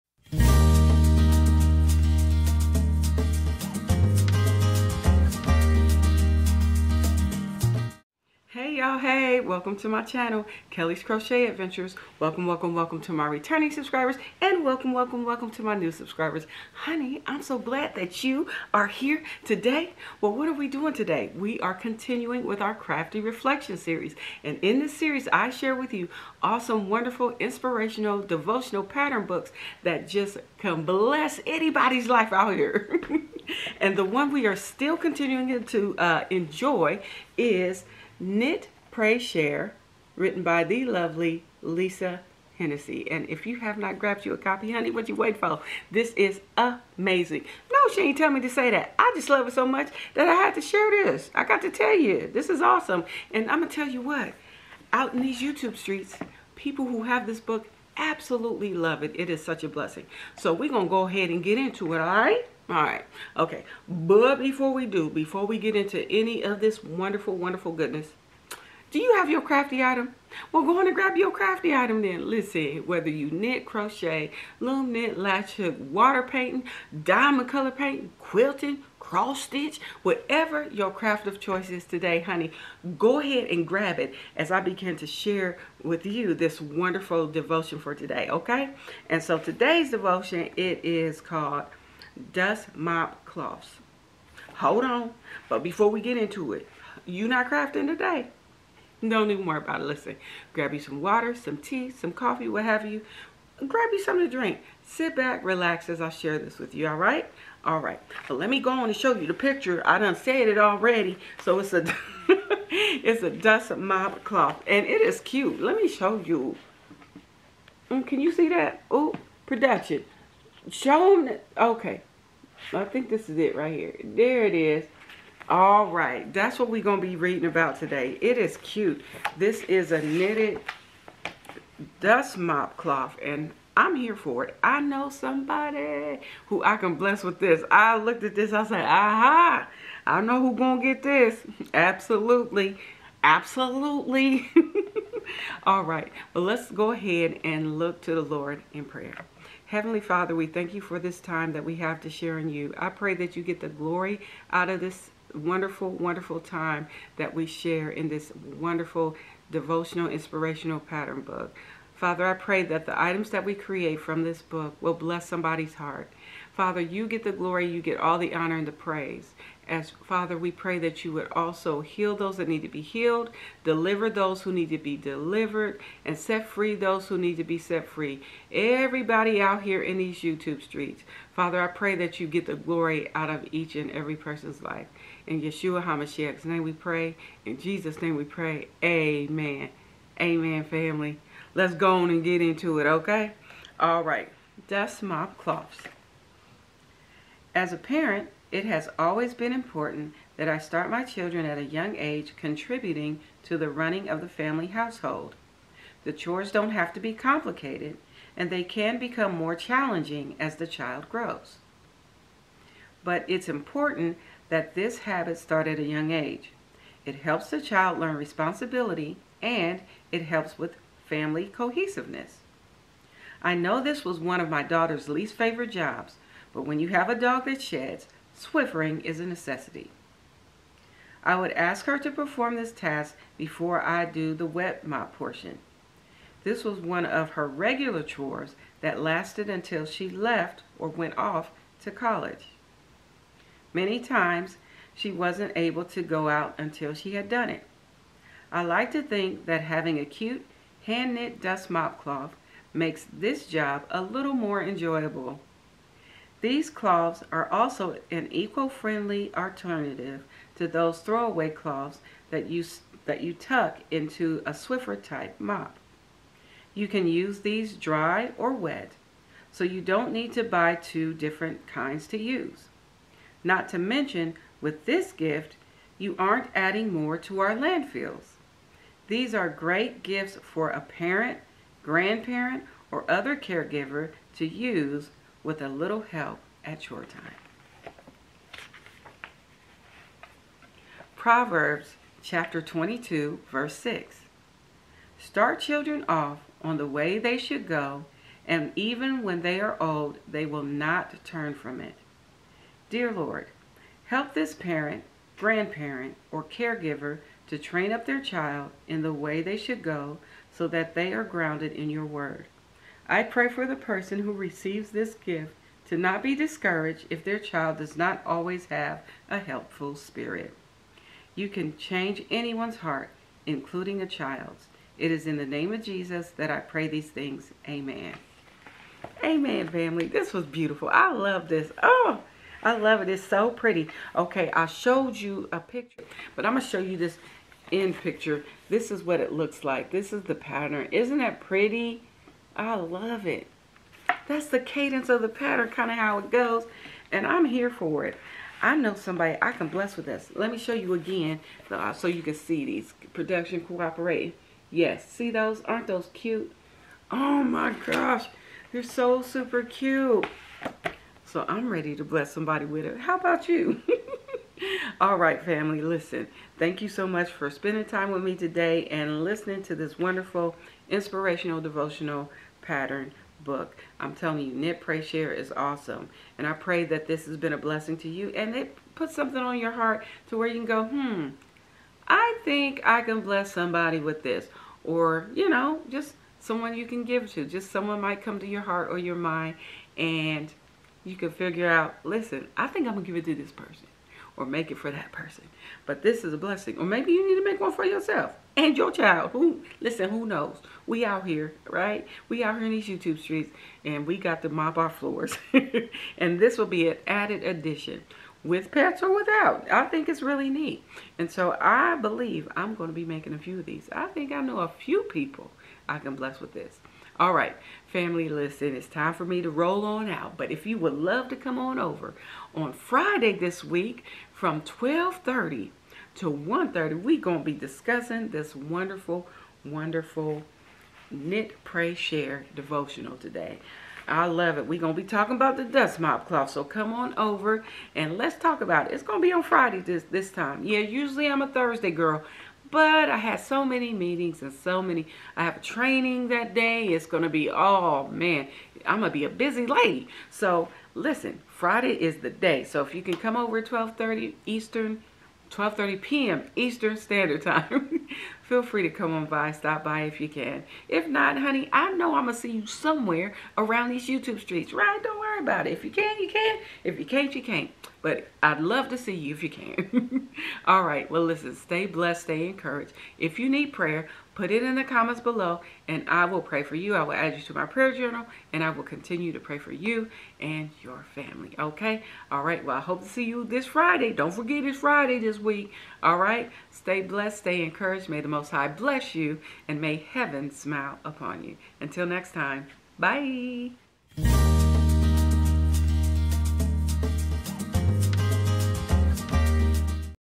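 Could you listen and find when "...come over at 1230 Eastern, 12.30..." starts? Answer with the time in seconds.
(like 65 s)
453 s.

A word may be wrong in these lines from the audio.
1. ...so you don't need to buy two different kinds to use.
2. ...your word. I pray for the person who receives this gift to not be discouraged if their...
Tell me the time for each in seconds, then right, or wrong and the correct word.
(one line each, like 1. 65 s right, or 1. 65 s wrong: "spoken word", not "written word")
1. 269 s right
2. 311 s right.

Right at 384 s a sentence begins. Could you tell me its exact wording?
Or, you know, just someone you can give to.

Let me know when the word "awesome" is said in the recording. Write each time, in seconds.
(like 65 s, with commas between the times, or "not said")
26 s, 52 s, 375 s.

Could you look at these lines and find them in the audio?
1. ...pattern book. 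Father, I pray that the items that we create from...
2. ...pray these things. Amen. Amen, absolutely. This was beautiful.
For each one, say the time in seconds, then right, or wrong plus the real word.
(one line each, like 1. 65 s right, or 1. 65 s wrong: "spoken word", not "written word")
1. 160 s right
2. 326 s wrong: "family", not "absolutely".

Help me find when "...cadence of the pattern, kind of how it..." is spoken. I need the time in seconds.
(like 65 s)
344 s.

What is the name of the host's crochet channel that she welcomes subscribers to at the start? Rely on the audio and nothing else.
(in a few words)
Kelli's Crochet Adventures.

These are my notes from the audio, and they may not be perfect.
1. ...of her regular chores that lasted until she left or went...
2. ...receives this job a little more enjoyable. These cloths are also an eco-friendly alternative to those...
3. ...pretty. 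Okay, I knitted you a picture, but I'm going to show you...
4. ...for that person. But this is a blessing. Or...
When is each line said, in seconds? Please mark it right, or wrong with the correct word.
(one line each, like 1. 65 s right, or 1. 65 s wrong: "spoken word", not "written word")
1. 237 s right
2. 252 s wrong: "makes", not "receives"
3. 333 s wrong: "showed", not "knitted"
4. 394 s right.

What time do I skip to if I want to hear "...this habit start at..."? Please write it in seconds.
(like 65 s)
214 s.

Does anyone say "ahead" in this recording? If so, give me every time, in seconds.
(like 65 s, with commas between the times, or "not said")
61 s, 83 s, 146 s.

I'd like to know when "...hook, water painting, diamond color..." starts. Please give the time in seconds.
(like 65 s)
75 s.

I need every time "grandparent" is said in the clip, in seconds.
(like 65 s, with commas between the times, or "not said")
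281 s, 305 s.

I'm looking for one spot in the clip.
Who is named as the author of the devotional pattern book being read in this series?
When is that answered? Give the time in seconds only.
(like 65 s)
41 s.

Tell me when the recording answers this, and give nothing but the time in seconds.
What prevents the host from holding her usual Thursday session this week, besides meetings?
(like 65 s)
445 s.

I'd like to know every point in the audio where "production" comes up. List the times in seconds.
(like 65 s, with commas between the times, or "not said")
119 s, 353 s.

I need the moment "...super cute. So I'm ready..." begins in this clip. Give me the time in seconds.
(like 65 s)
359 s.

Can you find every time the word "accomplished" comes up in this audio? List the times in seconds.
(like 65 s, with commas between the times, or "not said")
not said.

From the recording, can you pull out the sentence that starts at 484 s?
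Don't forget it's Friday this week.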